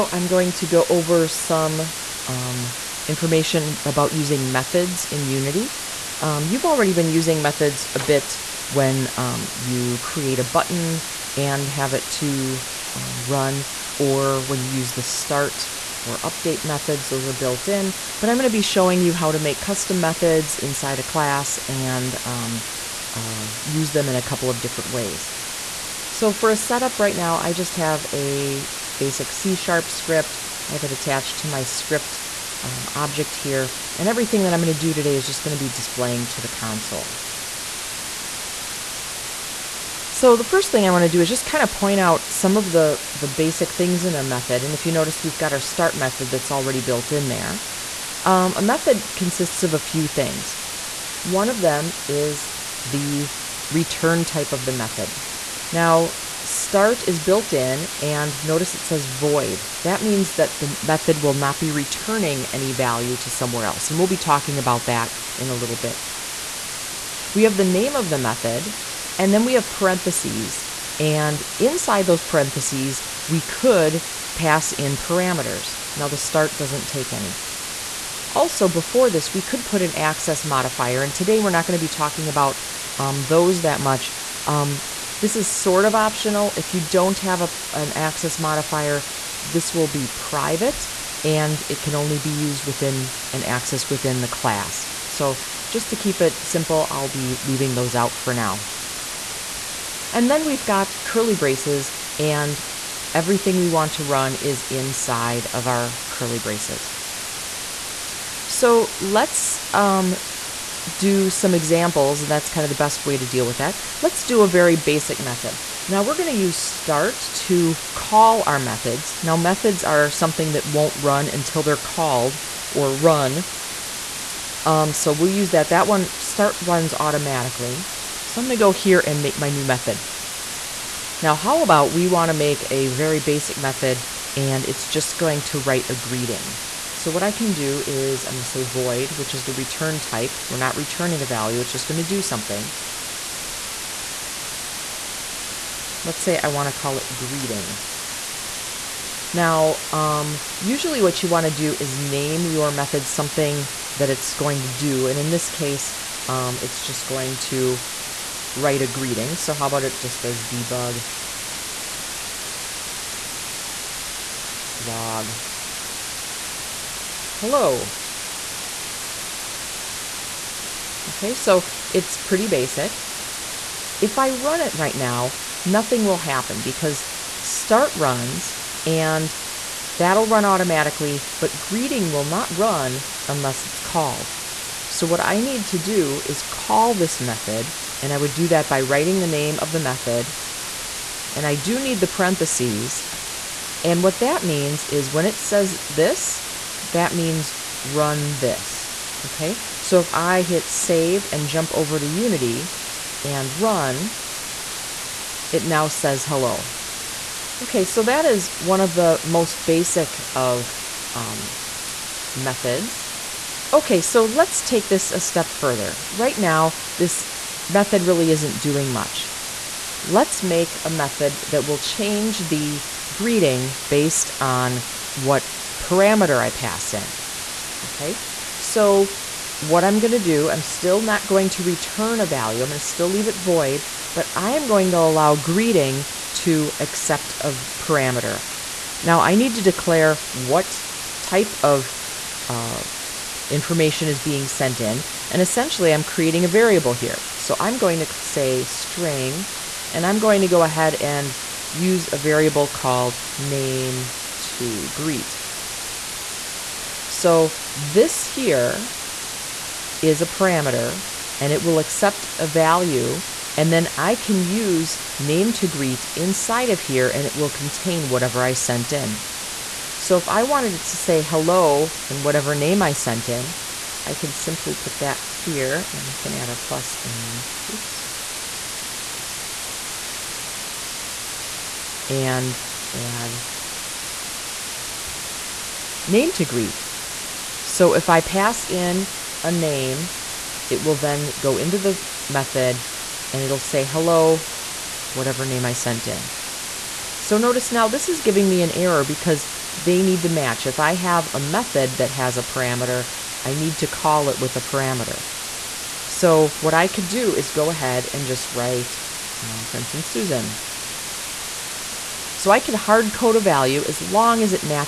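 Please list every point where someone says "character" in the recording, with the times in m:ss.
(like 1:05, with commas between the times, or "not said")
not said.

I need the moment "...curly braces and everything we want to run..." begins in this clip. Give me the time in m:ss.
1:41.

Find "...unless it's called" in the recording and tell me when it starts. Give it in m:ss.
3:03.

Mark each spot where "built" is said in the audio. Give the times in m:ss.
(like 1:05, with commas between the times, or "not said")
0:17, 0:46, 0:57.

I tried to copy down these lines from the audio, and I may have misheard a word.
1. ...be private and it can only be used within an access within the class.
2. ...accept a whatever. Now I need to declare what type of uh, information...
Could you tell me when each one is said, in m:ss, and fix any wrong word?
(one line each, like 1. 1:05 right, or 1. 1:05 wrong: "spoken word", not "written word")
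1. 1:29 right
2. 3:56 wrong: "parameter", not "whatever".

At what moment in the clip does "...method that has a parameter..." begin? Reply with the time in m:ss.
5:01.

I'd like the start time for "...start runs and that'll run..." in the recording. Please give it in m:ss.
2:57.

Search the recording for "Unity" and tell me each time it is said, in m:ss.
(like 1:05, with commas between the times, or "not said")
0:05, 3:22.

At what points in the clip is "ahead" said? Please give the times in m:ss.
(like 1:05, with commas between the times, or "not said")
4:10, 5:07.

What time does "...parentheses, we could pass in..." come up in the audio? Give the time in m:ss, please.
1:12.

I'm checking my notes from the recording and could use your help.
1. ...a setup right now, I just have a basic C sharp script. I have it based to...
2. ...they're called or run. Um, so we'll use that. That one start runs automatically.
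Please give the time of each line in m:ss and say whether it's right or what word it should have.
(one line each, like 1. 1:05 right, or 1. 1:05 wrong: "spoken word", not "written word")
1. 0:26 wrong: "attached", not "based"
2. 2:01 right.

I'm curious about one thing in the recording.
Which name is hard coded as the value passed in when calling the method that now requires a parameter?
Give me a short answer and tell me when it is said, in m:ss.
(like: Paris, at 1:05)
Susan, at 5:10.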